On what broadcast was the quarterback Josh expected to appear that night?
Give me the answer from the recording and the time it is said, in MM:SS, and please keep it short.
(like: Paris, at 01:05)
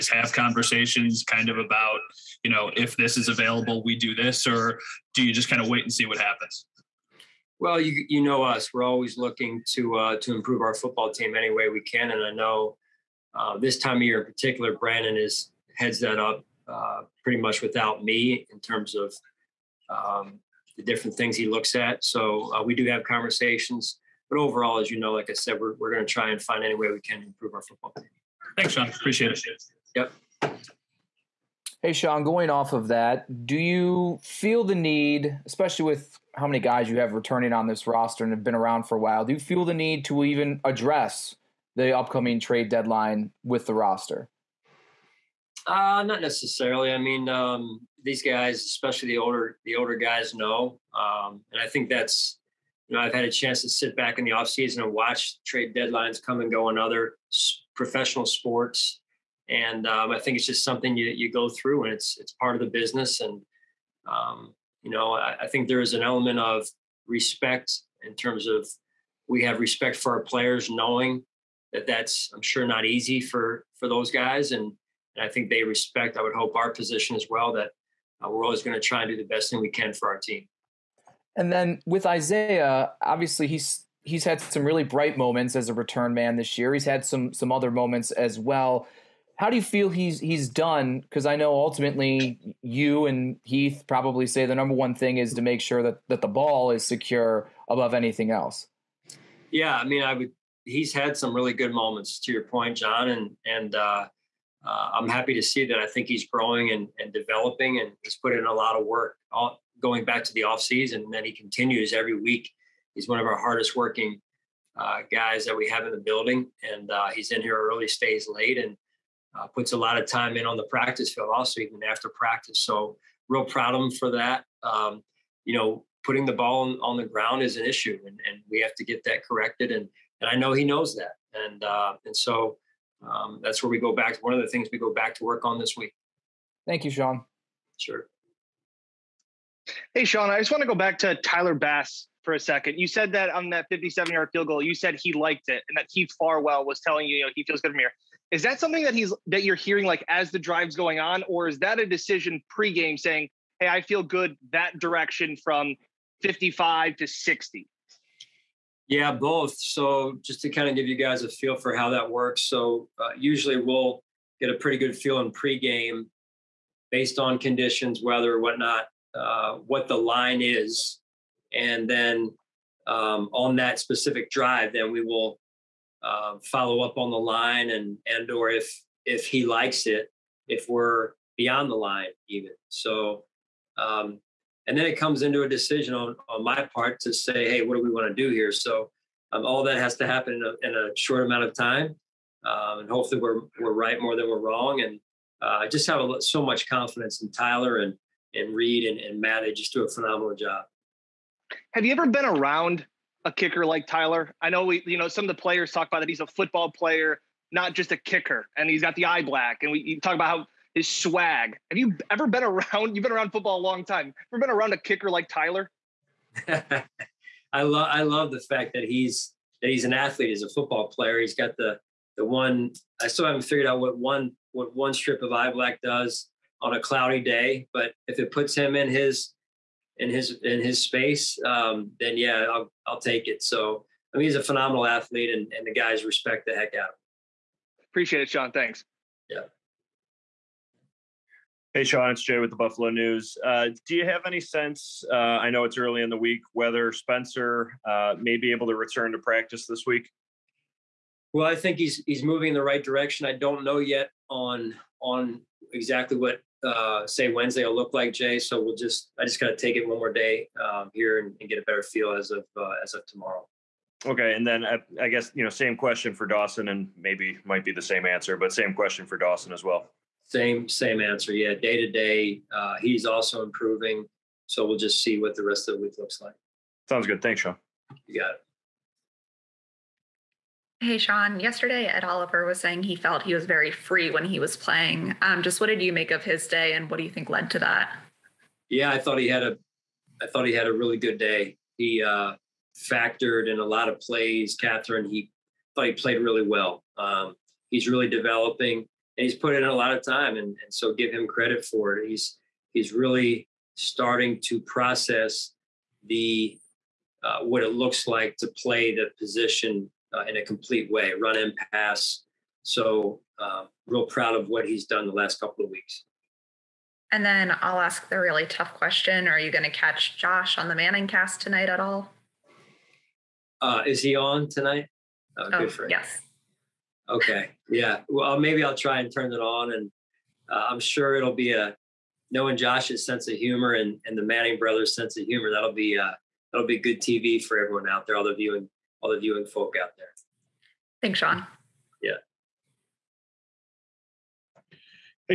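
Manning Cast, at 05:20.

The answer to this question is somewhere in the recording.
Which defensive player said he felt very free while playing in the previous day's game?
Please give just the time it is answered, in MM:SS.
04:41.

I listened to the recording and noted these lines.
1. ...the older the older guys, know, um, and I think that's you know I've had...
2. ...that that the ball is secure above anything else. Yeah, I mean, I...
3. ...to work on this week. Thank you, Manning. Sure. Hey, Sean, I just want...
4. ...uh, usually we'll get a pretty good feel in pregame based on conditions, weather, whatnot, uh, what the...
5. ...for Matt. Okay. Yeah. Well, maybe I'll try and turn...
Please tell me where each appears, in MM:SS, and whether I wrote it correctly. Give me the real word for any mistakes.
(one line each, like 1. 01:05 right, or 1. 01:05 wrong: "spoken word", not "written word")
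1. 00:49 right
2. 01:35 right
3. 02:15 wrong: "Sean", not "Manning"
4. 02:42 right
5. 05:25 wrong: "Yes", not "Matt".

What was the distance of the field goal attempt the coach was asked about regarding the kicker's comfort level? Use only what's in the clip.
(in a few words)
57 yards.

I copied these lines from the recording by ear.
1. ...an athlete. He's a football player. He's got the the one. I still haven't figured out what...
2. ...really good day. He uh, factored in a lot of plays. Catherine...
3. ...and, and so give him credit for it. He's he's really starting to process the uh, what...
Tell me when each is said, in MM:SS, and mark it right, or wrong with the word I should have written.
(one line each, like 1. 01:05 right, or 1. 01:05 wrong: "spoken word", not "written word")
1. 03:39 right
2. 04:50 right
3. 05:00 right.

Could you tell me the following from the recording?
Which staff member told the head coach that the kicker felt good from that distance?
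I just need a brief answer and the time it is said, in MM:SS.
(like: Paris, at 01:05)
Heath Farwell, at 02:25.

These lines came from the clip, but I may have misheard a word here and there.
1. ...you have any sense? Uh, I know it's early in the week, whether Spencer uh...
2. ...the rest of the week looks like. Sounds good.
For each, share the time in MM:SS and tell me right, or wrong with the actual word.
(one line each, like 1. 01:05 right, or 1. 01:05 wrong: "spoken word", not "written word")
1. 04:03 right
2. 04:35 right.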